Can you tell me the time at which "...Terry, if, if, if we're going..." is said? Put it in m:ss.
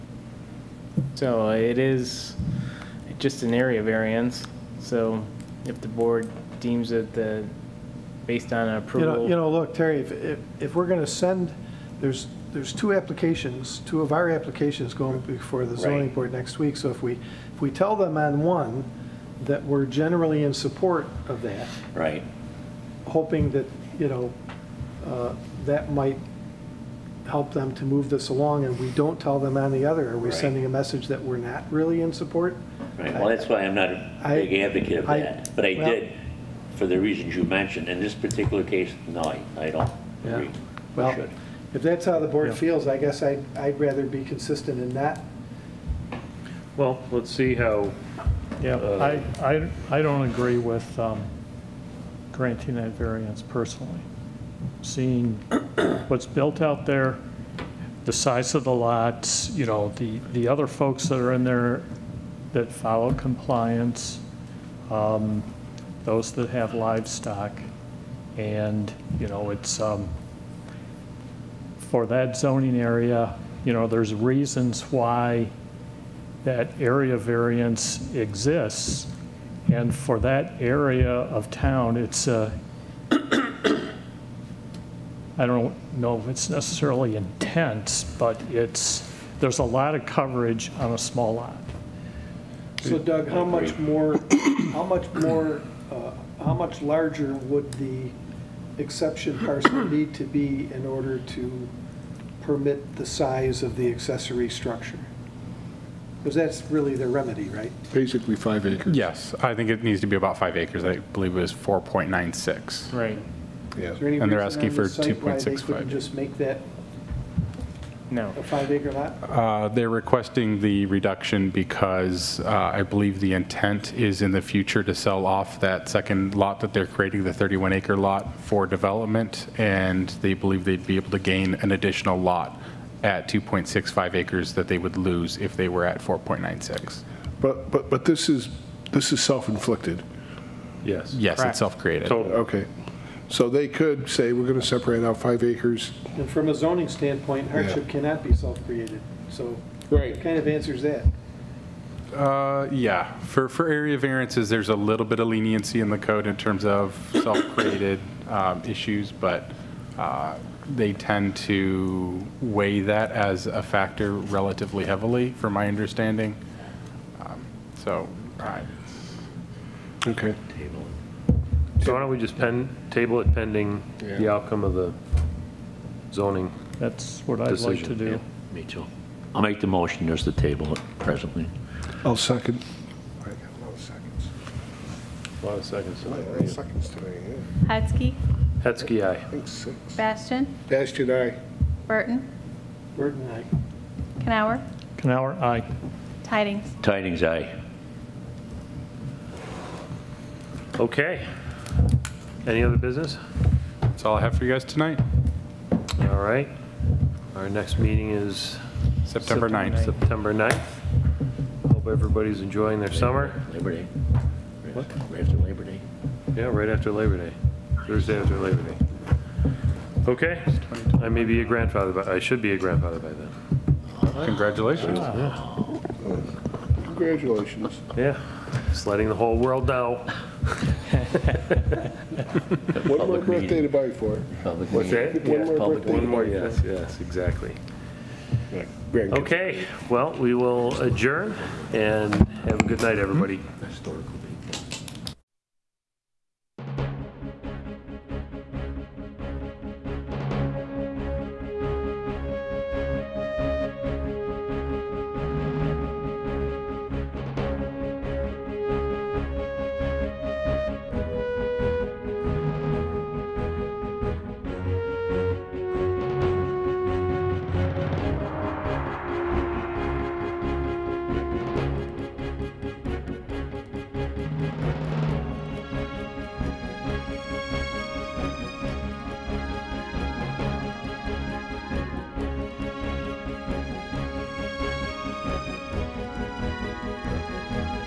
0:09.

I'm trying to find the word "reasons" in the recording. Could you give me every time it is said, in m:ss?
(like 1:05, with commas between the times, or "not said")
0:36, 1:14.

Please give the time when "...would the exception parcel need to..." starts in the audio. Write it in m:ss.
1:37.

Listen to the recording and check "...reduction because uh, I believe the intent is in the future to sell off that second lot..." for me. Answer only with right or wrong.
right.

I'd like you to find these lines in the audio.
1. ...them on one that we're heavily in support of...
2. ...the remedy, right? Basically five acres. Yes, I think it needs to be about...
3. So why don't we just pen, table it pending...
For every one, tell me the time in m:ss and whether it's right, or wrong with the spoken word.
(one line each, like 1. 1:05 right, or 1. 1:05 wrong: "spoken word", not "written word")
1. 0:17 wrong: "generally", not "heavily"
2. 1:46 right
3. 2:51 right.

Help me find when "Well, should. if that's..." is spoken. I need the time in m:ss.
0:40.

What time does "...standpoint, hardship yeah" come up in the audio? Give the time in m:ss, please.
2:26.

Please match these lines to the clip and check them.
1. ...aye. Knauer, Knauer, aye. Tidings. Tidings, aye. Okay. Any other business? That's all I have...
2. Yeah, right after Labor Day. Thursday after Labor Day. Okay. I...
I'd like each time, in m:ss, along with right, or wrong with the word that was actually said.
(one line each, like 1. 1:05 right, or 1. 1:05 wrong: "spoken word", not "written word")
1. 3:13 right
2. 3:36 right.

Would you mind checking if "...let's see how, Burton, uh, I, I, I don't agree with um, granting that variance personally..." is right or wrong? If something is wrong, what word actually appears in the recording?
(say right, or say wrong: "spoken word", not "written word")
wrong: "Yeah", not "Burton".